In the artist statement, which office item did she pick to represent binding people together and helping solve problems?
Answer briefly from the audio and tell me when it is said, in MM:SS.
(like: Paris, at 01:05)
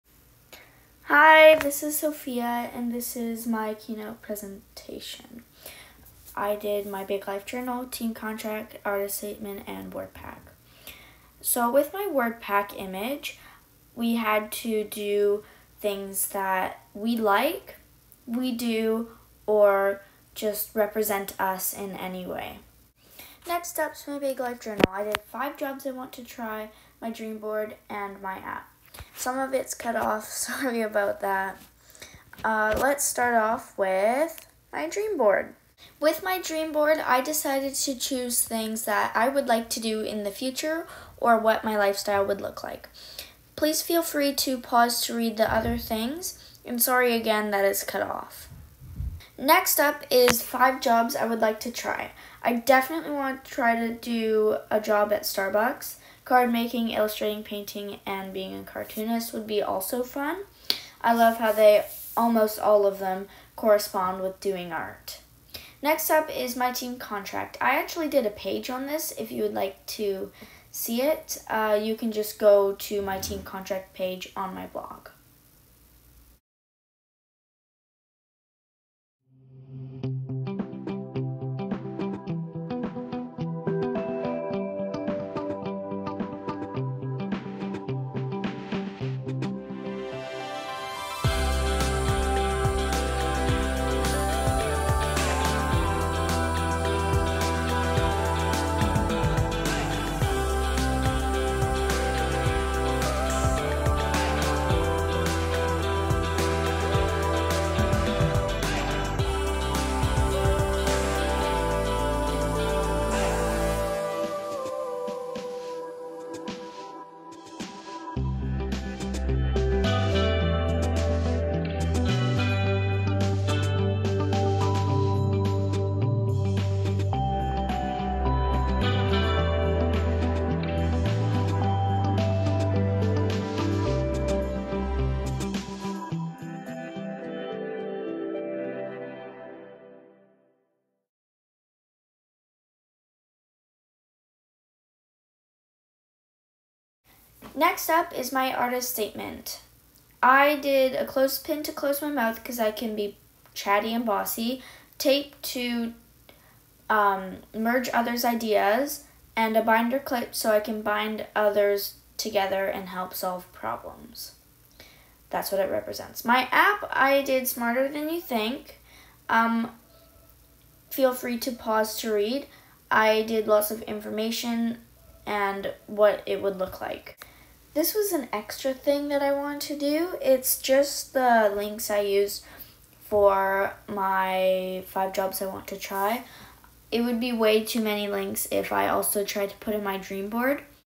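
binder clip, at 02:39.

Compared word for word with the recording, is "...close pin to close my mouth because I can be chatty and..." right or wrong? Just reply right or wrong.
right.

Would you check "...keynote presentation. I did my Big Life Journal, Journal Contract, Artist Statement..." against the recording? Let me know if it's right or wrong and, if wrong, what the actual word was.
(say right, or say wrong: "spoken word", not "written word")
wrong: "Team", not "Journal".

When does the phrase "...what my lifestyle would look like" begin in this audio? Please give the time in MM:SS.
00:41.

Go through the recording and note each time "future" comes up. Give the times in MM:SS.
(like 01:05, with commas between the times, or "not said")
00:40.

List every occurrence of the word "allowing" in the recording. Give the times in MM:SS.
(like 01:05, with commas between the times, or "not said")
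not said.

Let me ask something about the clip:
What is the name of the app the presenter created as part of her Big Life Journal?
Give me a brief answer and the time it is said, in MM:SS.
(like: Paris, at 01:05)
Smarter Than You Think, at 02:47.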